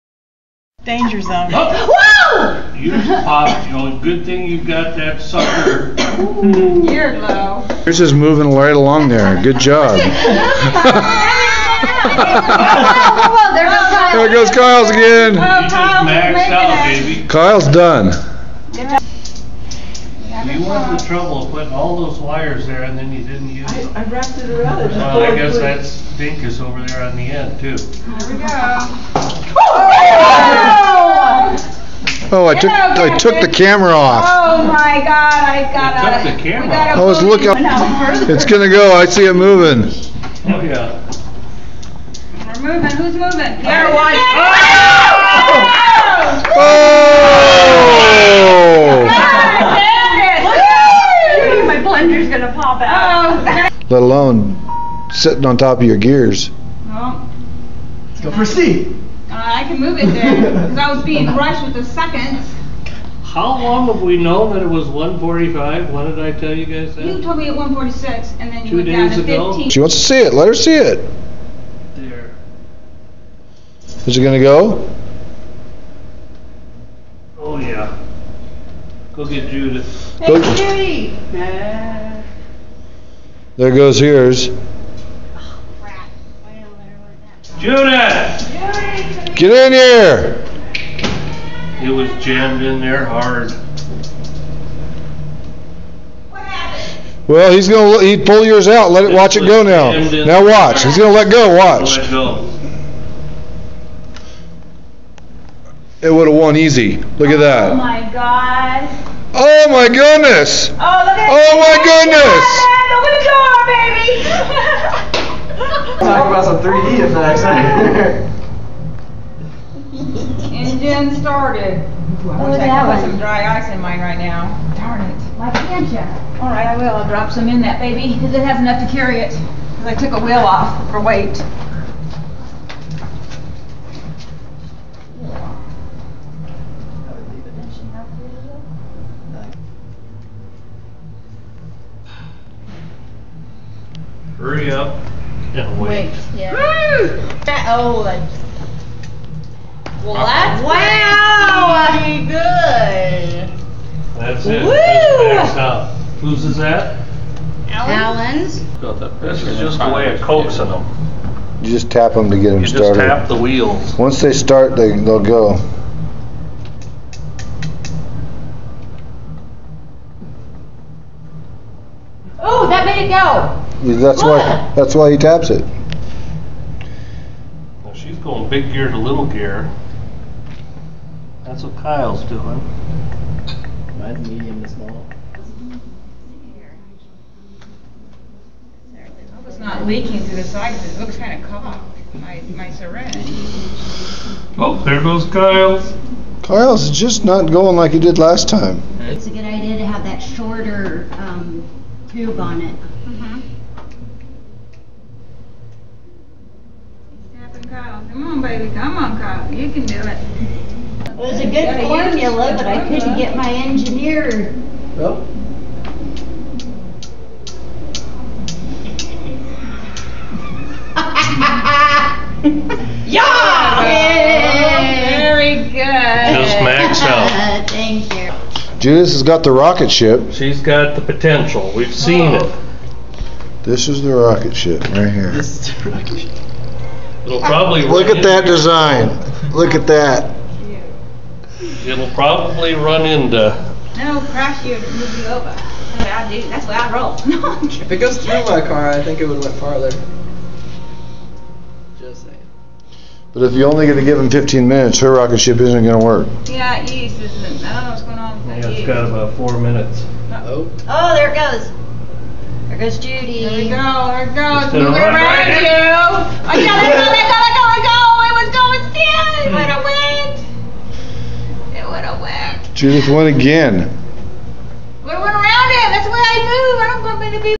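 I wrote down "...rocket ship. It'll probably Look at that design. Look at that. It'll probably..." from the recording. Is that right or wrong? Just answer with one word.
right.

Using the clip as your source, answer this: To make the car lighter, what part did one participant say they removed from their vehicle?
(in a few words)
a wheel.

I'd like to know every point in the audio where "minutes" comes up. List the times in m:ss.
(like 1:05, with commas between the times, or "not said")
4:14, 4:19.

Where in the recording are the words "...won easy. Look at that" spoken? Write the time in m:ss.
1:46.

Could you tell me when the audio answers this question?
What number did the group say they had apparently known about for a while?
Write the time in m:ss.
1:04.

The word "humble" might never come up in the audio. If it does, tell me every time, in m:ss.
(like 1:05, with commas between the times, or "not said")
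not said.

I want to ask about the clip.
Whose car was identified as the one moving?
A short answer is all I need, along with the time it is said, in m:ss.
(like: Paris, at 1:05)
Allen, at 2:37.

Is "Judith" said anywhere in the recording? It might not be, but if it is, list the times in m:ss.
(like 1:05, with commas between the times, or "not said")
1:19, 1:27, 3:48, 4:32.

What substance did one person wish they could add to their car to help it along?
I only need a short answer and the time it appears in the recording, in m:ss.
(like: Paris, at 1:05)
dry ice, at 2:03.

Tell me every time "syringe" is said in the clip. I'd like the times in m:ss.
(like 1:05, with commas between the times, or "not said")
3:12.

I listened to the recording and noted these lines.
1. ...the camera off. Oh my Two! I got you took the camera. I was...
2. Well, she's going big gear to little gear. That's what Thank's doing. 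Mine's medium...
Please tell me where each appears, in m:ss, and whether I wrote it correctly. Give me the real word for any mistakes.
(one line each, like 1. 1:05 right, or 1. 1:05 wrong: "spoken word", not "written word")
1. 0:33 wrong: "God", not "Two"
2. 2:57 wrong: "Kyle", not "Thank".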